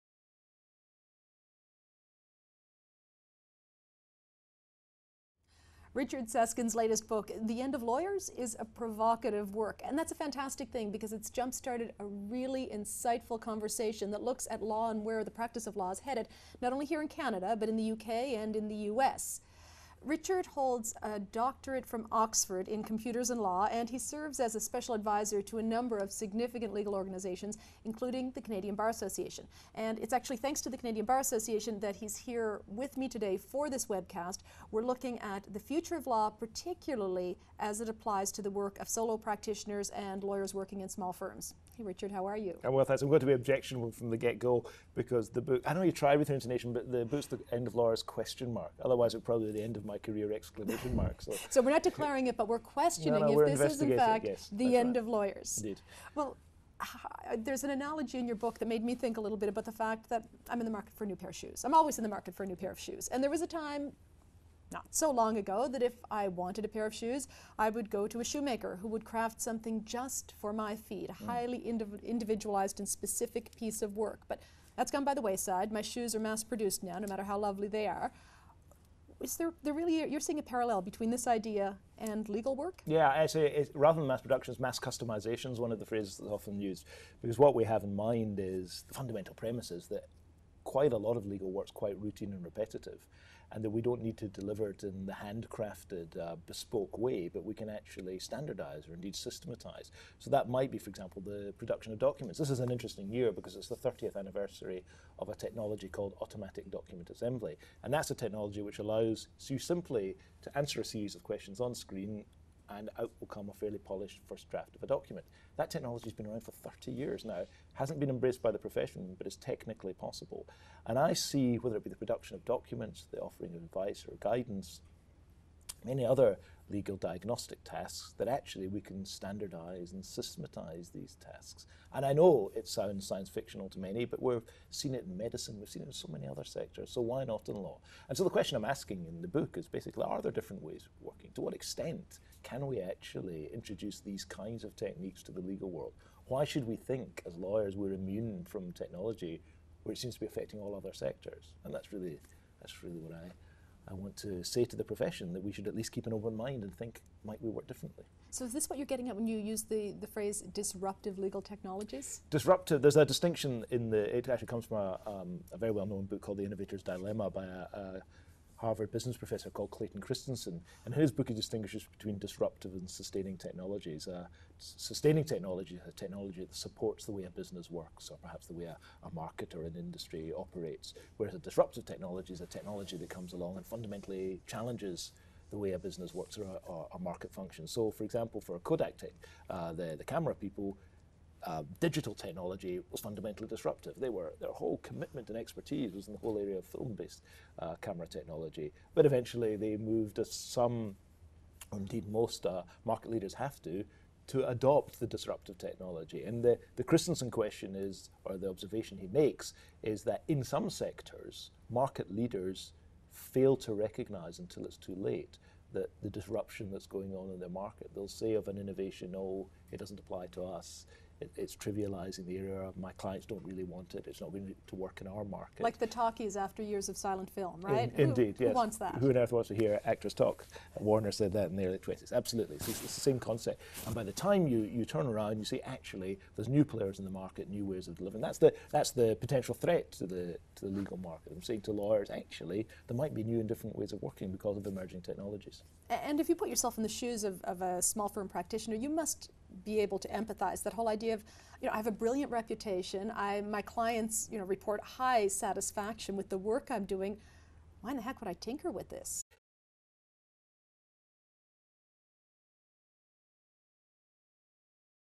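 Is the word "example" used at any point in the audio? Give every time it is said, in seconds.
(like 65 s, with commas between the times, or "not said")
100 s, 188 s.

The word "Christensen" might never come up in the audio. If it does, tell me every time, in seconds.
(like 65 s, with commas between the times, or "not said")
170 s, 206 s.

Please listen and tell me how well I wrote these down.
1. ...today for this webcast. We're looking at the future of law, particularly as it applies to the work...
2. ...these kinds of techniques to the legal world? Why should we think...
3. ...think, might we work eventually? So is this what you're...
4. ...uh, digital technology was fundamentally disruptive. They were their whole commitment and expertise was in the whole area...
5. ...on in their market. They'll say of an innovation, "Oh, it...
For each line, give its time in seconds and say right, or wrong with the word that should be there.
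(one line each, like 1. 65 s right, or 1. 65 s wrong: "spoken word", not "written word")
1. 33 s right
2. 143 s right
3. 156 s wrong: "differently", not "eventually"
4. 191 s right
5. 217 s right.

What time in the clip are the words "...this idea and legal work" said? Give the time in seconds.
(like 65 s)
81 s.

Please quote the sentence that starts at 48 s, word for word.
Otherwise, it would probably be the end of my career exclamation mark.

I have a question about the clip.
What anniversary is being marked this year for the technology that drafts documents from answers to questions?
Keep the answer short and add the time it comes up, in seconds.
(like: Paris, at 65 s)
30th, at 103 s.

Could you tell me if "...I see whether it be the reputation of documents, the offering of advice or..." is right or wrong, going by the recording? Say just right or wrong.
wrong.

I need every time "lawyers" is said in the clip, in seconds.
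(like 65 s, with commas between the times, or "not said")
7 s, 40 s, 47 s, 55 s, 147 s, 241 s.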